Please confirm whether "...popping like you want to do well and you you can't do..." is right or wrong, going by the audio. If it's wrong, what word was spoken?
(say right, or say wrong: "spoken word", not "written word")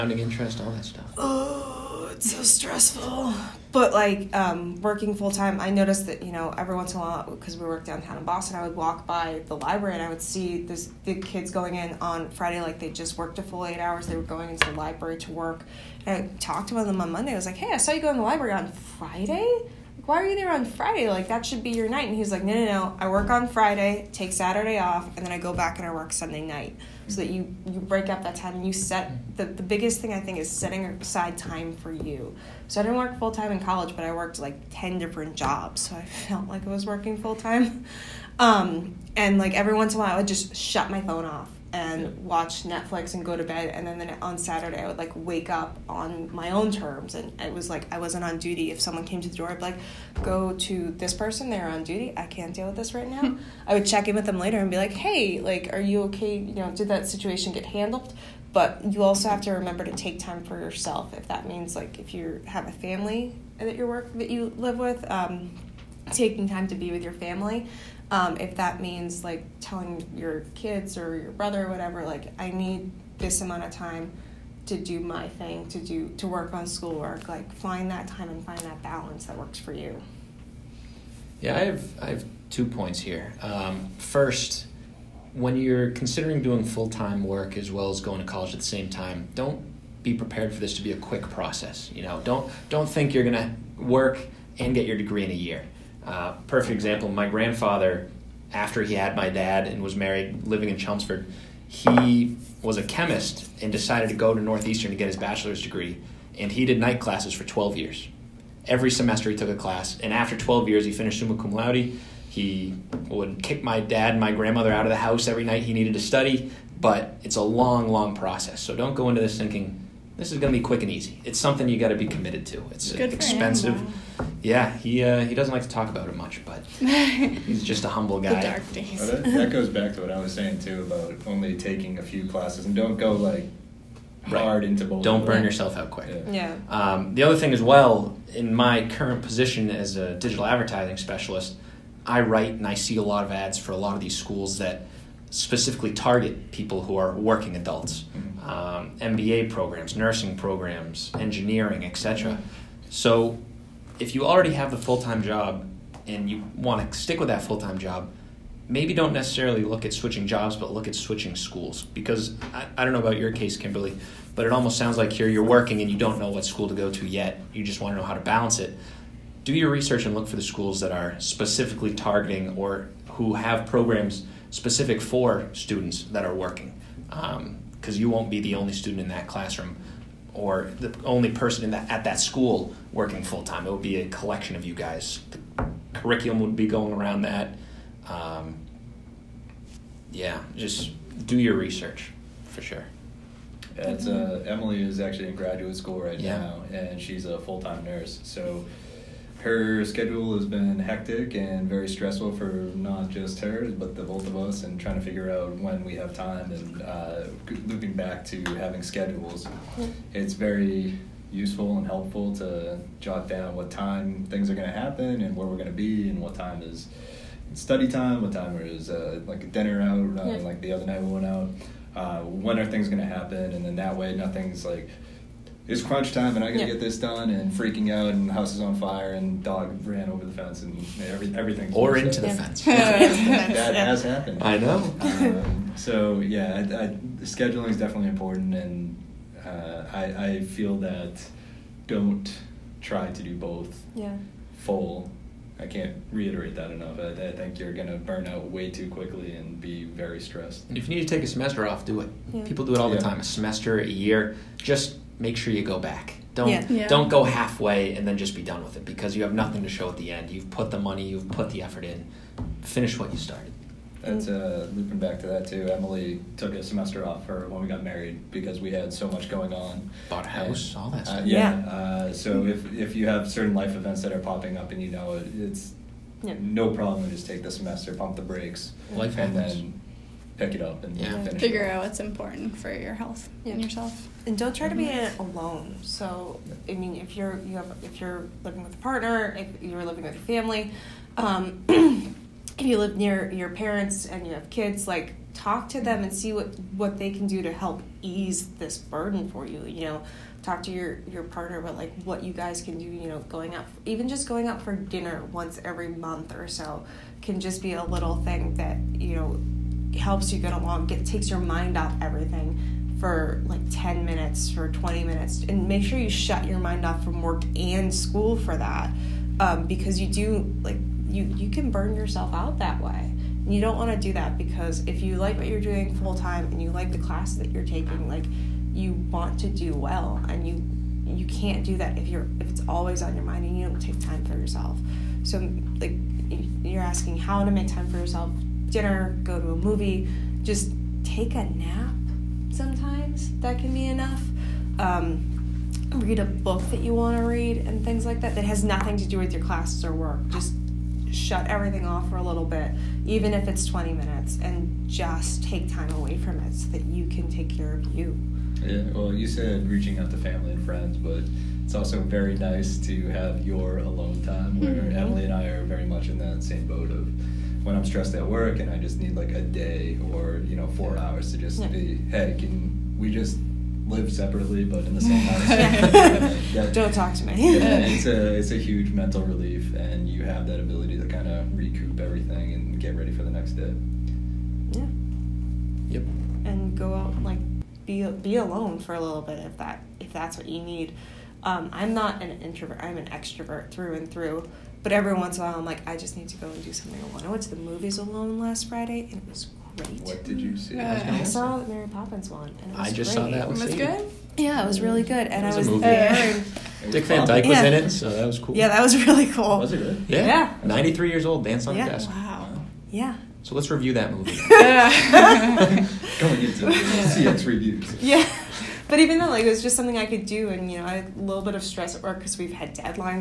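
wrong: "taking", not "popping".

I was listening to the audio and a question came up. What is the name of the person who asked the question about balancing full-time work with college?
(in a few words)
Kimberly.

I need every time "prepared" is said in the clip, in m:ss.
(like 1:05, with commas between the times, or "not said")
1:30.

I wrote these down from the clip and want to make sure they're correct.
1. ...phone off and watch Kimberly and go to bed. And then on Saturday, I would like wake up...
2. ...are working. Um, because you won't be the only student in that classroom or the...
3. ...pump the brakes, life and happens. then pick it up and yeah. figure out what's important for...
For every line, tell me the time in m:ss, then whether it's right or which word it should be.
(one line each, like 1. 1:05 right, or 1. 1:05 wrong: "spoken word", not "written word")
1. 0:41 wrong: "Netflix", not "Kimberly"
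2. 2:56 right
3. 4:37 right.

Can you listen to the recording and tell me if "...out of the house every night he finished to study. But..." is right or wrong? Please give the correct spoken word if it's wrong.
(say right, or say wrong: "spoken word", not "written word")
wrong: "needed", not "finished".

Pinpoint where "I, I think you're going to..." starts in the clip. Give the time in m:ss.
4:06.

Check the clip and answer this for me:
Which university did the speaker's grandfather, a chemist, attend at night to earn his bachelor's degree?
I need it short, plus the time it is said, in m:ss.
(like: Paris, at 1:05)
Northeastern, at 1:44.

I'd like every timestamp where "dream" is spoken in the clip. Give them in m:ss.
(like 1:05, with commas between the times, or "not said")
not said.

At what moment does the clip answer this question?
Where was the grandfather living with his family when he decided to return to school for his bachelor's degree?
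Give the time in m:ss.
1:40.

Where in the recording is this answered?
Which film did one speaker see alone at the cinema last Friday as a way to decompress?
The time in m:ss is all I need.
6:41.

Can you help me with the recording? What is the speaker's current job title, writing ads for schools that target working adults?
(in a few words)
digital advertising specialist.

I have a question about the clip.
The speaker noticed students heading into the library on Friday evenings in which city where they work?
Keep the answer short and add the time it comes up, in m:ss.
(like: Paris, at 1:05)
Boston, at 0:08.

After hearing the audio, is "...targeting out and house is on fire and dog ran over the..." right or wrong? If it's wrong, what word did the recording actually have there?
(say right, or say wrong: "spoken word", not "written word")
wrong: "freaking", not "targeting".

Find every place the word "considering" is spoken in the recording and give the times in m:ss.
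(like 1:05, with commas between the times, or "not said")
1:25.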